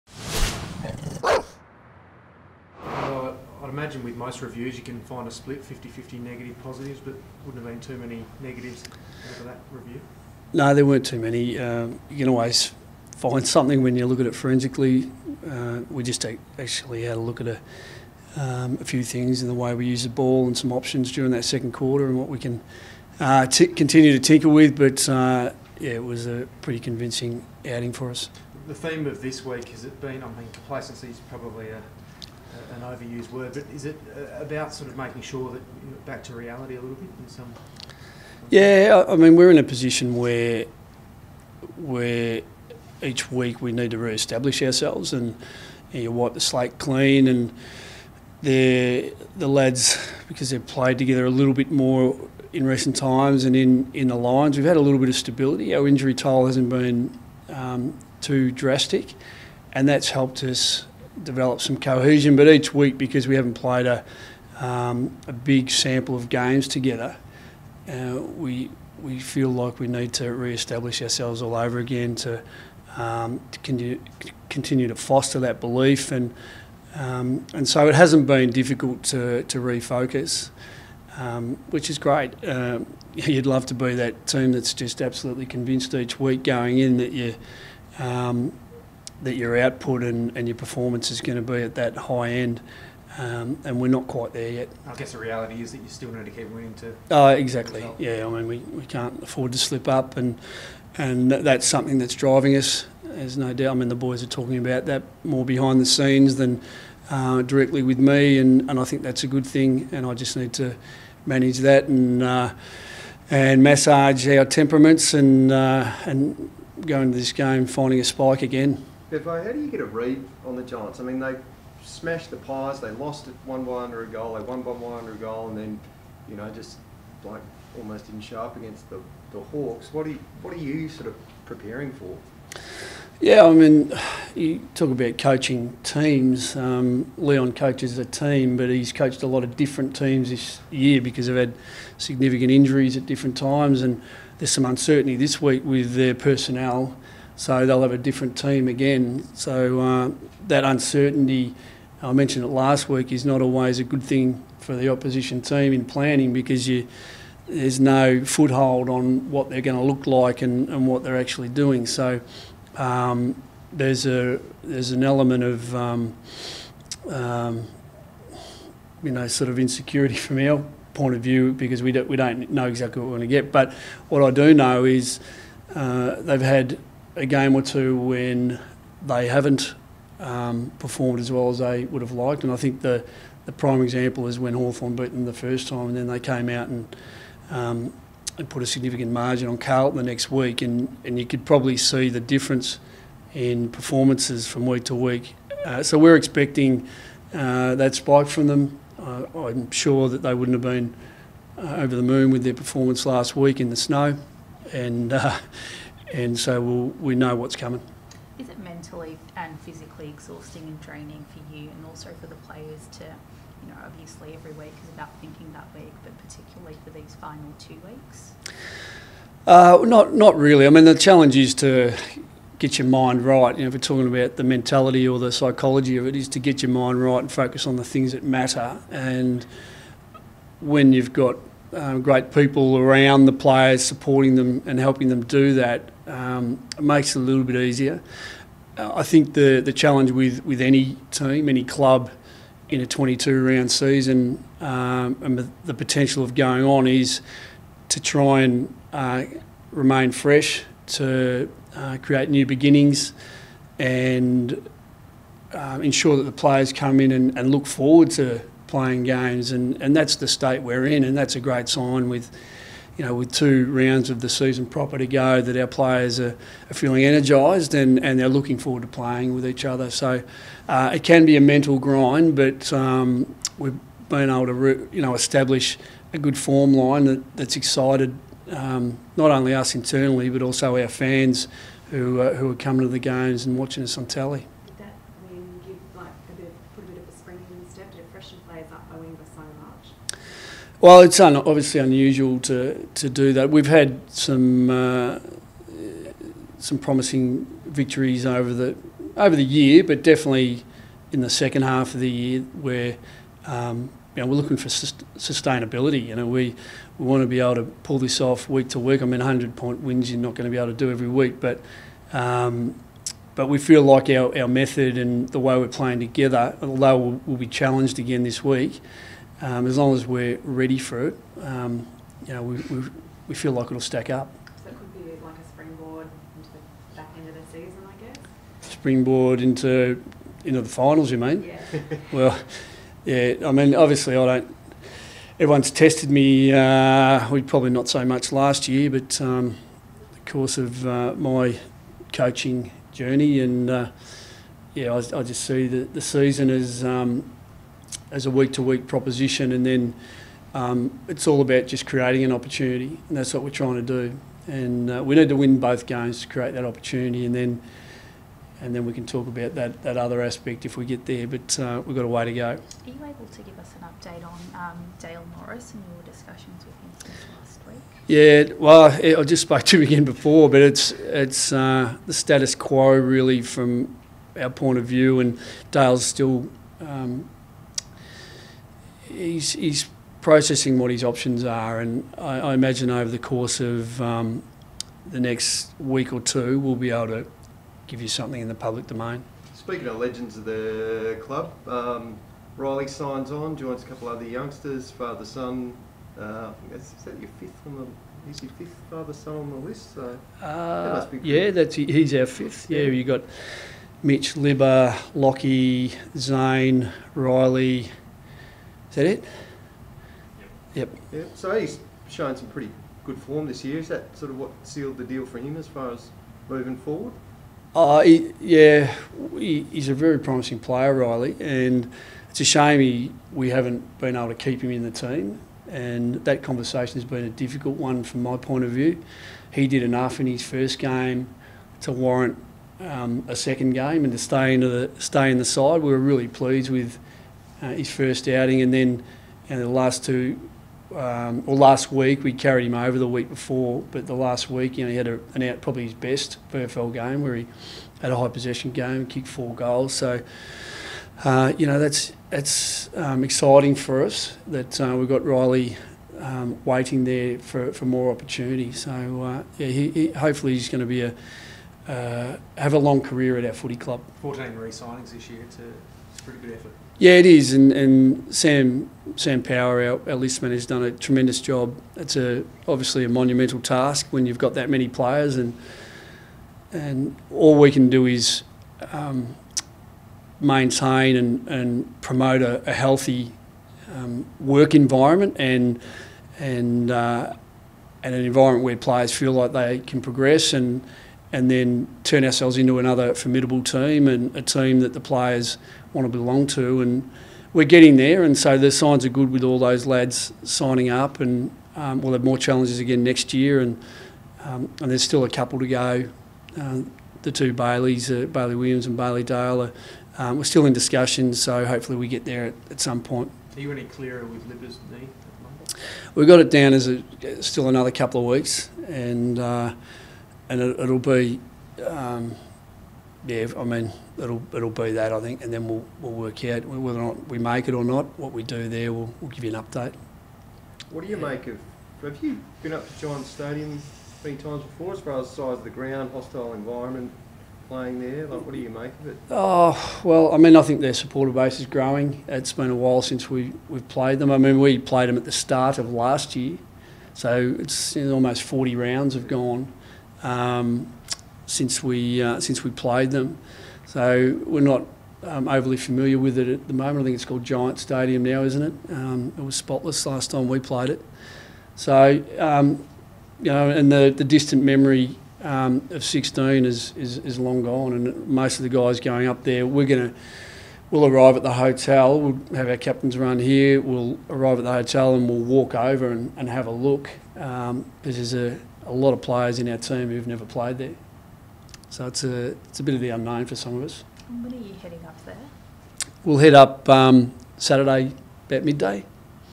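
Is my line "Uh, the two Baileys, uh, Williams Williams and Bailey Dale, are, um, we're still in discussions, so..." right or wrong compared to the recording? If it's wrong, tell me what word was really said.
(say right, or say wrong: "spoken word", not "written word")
wrong: "Bailey", not "Williams".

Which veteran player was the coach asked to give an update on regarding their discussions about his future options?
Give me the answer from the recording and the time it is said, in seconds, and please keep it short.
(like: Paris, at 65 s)
Dale Morris, at 364 s.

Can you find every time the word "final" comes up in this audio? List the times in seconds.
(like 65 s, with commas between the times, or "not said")
217 s, 330 s.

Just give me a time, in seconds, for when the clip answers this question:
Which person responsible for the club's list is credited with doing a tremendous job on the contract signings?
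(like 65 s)
469 s.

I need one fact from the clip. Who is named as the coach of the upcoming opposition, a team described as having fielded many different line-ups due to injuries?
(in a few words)
Leon.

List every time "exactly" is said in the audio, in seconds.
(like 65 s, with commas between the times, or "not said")
97 s, 172 s.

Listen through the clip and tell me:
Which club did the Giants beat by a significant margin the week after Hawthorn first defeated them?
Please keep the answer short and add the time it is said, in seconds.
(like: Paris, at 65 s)
Carlton, at 189 s.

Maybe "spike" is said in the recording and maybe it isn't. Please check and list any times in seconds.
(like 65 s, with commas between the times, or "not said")
118 s, 197 s.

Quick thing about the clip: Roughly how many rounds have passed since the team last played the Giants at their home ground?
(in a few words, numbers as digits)
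40.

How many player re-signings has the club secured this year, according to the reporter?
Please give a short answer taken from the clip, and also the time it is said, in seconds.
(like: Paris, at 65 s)
14, at 464 s.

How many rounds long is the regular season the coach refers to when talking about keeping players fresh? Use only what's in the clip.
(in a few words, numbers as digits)
22.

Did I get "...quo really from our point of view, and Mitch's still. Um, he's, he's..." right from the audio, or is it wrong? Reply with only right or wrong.
wrong.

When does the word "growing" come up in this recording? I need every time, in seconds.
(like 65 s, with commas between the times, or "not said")
541 s.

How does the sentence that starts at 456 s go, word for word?
Um, waiting there for, for more opportunity.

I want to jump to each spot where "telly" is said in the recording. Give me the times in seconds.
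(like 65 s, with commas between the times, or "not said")
284 s.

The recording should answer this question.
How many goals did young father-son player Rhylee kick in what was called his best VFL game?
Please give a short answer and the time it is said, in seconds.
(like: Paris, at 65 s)
4, at 449 s.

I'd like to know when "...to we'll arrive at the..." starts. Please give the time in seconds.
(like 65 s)
570 s.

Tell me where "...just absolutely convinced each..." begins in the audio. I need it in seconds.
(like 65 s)
84 s.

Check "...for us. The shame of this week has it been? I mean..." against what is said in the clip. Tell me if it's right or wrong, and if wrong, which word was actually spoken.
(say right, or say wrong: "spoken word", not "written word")
wrong: "theme", not "shame".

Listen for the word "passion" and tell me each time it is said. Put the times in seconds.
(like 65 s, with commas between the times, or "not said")
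not said.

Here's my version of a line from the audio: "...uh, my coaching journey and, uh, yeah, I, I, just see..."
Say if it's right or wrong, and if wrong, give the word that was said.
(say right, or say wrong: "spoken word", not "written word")
right.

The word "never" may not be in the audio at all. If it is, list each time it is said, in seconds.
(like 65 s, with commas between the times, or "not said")
580 s.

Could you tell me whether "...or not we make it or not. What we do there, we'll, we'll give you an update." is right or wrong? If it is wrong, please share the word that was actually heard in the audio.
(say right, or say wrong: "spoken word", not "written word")
right.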